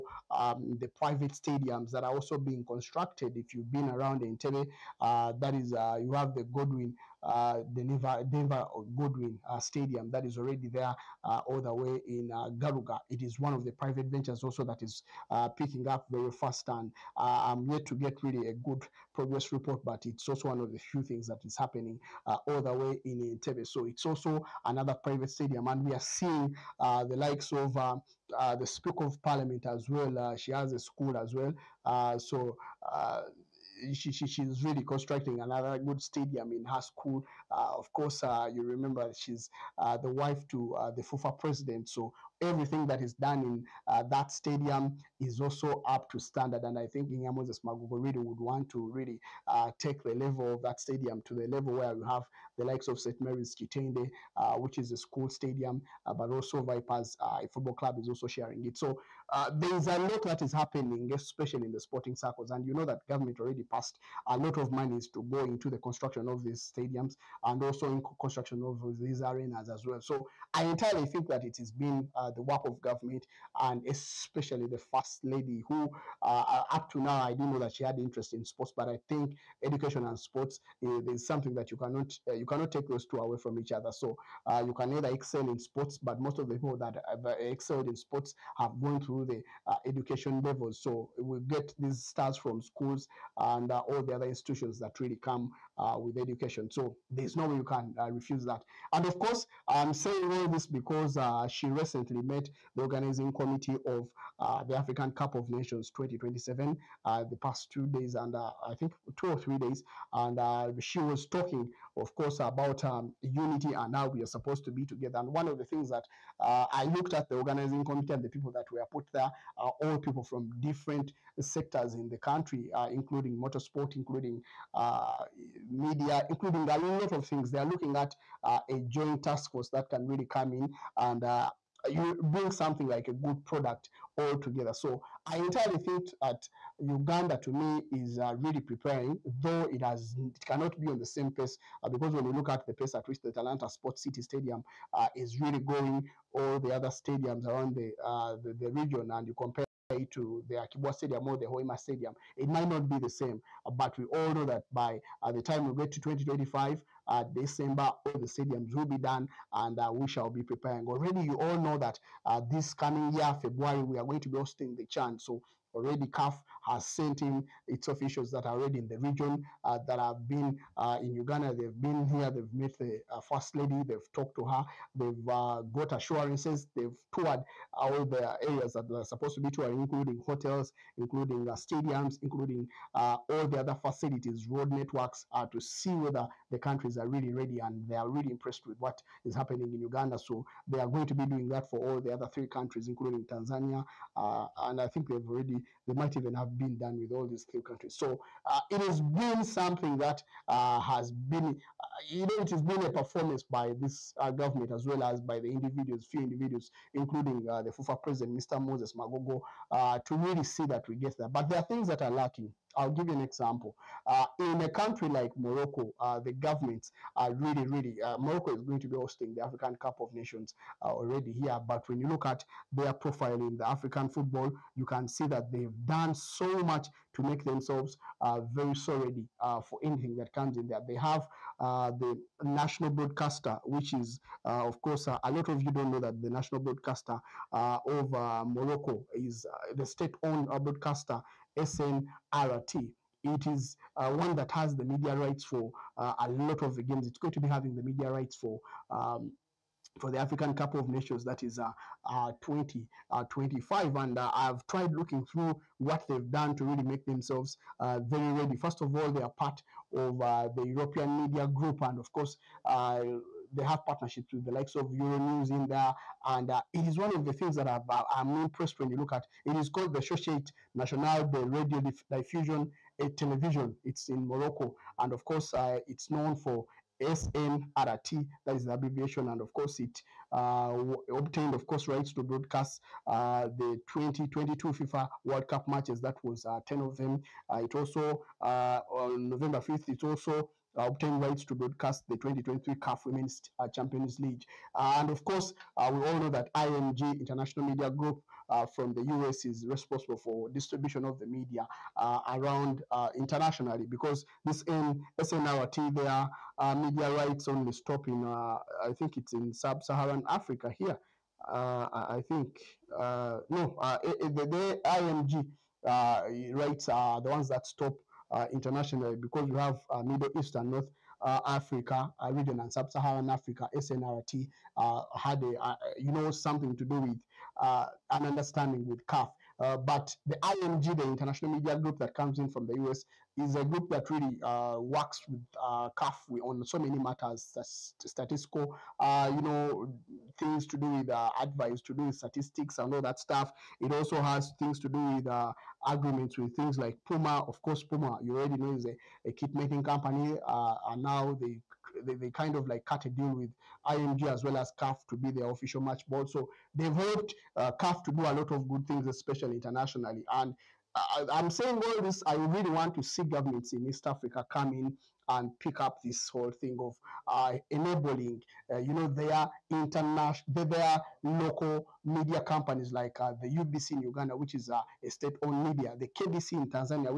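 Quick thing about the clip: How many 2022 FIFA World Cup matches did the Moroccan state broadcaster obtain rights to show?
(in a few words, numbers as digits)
10.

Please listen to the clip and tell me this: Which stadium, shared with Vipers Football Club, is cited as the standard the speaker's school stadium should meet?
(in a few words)
St. Mary's Kitende.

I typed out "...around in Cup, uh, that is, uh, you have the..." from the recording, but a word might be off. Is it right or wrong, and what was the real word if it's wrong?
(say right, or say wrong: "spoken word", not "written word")
wrong: "Entebbe", not "Cup".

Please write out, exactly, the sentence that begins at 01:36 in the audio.
So there's no way you can uh, refuse that.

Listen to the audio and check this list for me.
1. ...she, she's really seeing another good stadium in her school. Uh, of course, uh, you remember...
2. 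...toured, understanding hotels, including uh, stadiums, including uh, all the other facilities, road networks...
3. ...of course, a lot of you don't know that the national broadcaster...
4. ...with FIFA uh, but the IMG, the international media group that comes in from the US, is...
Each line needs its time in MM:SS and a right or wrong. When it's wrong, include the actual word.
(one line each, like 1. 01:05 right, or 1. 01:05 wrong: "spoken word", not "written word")
1. 00:34 wrong: "constructing", not "seeing"
2. 02:59 wrong: "including", not "understanding"
3. 03:54 right
4. 05:28 wrong: "CAF", not "FIFA".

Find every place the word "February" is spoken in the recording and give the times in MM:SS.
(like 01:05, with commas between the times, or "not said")
02:43.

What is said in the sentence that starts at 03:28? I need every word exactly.
Moses Magogo, uh, to really see that we get there.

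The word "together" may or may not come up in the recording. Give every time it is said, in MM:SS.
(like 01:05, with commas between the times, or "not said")
01:54, 02:14.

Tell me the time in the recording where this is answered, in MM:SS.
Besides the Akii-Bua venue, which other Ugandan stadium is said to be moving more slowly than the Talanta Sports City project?
02:31.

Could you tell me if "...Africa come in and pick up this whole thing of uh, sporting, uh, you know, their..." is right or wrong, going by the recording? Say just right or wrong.
wrong.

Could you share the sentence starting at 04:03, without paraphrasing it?
It is uh, one that has the media rights for uh, a lot of the games.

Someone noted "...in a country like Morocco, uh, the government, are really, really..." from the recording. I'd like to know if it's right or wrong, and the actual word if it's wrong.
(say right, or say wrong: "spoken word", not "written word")
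right.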